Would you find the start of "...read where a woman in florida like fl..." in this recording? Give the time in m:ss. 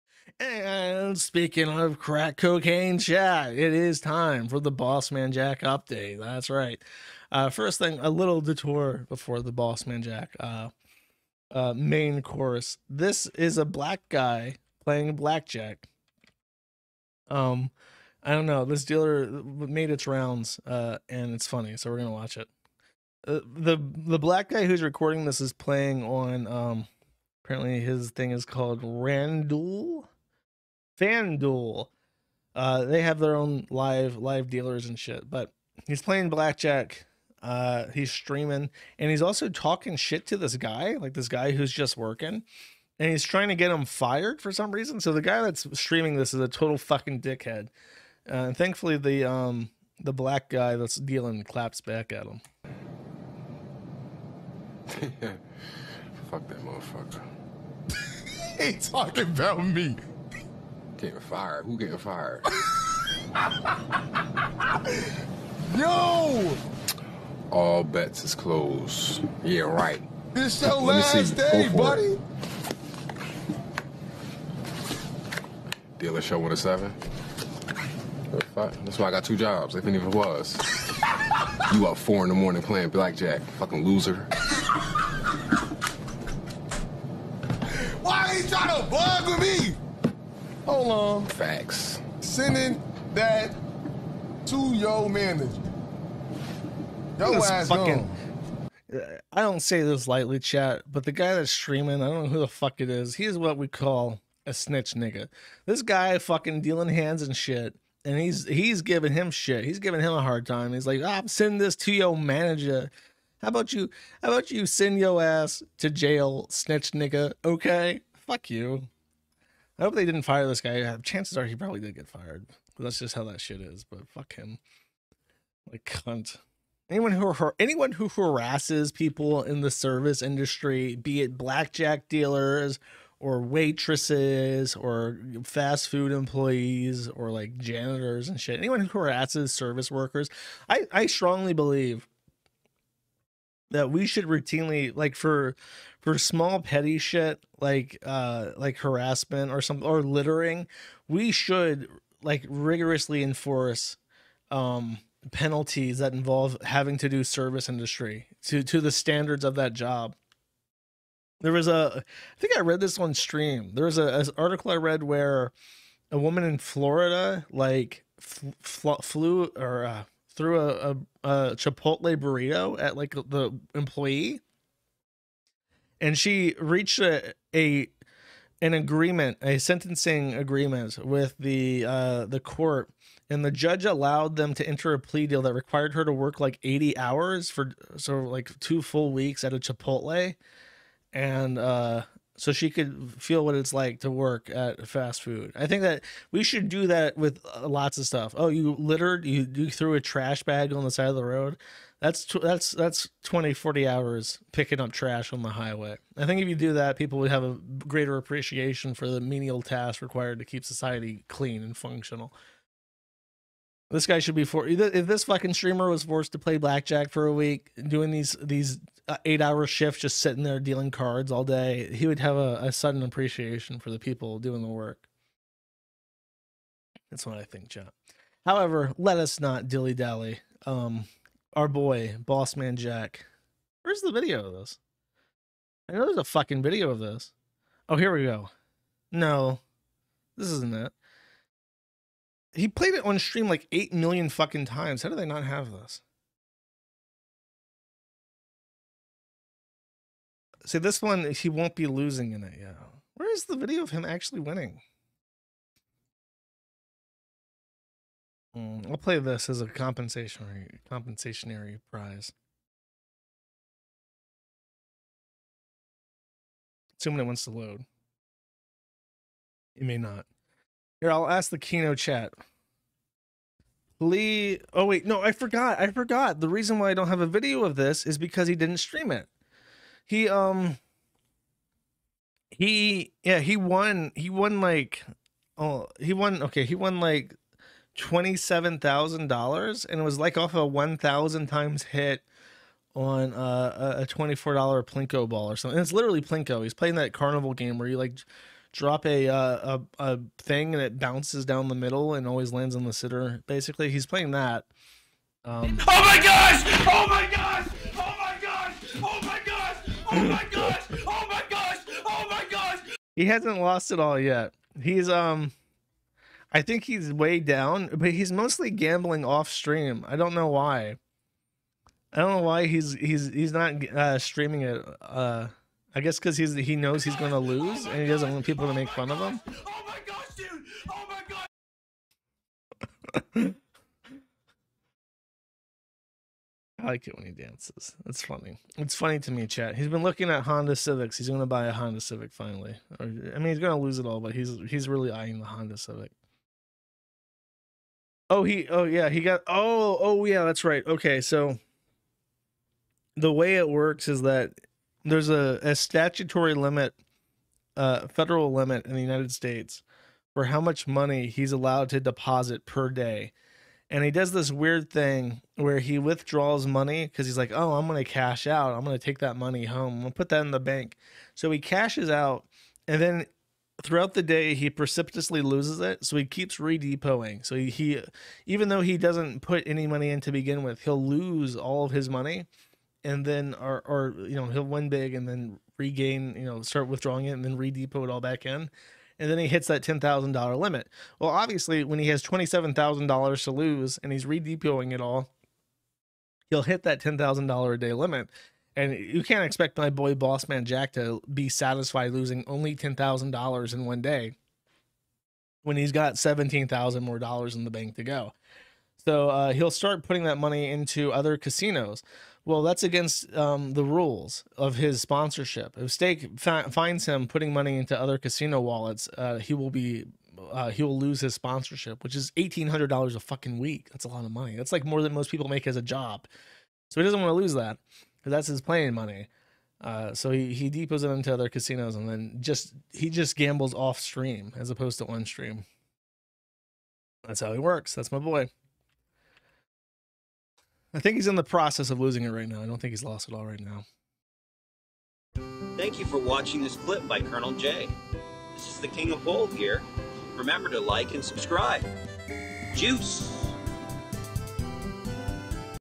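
2:44.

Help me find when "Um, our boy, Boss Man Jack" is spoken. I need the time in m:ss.
3:50.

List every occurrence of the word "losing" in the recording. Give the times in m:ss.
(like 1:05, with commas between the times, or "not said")
4:11, 6:42, 7:21.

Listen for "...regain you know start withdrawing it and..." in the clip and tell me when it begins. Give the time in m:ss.
6:25.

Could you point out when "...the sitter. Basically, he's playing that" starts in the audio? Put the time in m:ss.
5:02.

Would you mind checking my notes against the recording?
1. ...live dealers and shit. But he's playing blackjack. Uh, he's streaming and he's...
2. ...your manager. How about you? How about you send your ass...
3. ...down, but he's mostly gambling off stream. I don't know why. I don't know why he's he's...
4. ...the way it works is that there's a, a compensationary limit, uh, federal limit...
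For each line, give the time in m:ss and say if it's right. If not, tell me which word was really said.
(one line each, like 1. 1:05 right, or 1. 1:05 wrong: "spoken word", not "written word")
1. 0:34 right
2. 1:51 right
3. 5:17 right
4. 5:53 wrong: "statutory", not "compensationary".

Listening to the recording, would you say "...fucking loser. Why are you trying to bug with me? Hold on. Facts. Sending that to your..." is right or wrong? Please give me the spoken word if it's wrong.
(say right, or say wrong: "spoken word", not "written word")
right.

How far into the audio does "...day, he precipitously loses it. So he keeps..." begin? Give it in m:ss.
6:14.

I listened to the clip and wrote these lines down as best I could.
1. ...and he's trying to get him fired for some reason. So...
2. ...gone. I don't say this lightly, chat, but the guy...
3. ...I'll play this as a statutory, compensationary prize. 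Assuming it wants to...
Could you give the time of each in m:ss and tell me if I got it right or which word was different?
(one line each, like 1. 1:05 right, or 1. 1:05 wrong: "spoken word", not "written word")
1. 0:42 right
2. 1:38 right
3. 4:18 wrong: "compensationary", not "statutory".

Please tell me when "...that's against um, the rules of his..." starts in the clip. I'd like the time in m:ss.
6:52.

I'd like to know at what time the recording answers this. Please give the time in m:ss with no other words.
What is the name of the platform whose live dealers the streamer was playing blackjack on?
0:30.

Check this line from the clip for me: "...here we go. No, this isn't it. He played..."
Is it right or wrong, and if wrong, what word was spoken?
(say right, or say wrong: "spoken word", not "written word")
right.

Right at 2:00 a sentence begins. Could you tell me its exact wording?
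Uh, chances are he probably did get fired.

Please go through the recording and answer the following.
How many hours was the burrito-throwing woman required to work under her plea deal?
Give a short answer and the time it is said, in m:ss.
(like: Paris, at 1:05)
80, at 3:06.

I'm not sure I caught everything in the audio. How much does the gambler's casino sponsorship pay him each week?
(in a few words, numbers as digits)
$1,800.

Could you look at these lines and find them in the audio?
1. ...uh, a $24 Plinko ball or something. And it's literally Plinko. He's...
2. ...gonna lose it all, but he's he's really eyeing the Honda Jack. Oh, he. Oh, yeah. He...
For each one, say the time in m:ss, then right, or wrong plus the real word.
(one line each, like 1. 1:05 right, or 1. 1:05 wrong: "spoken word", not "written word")
1. 4:53 right
2. 5:43 wrong: "Civic", not "Jack".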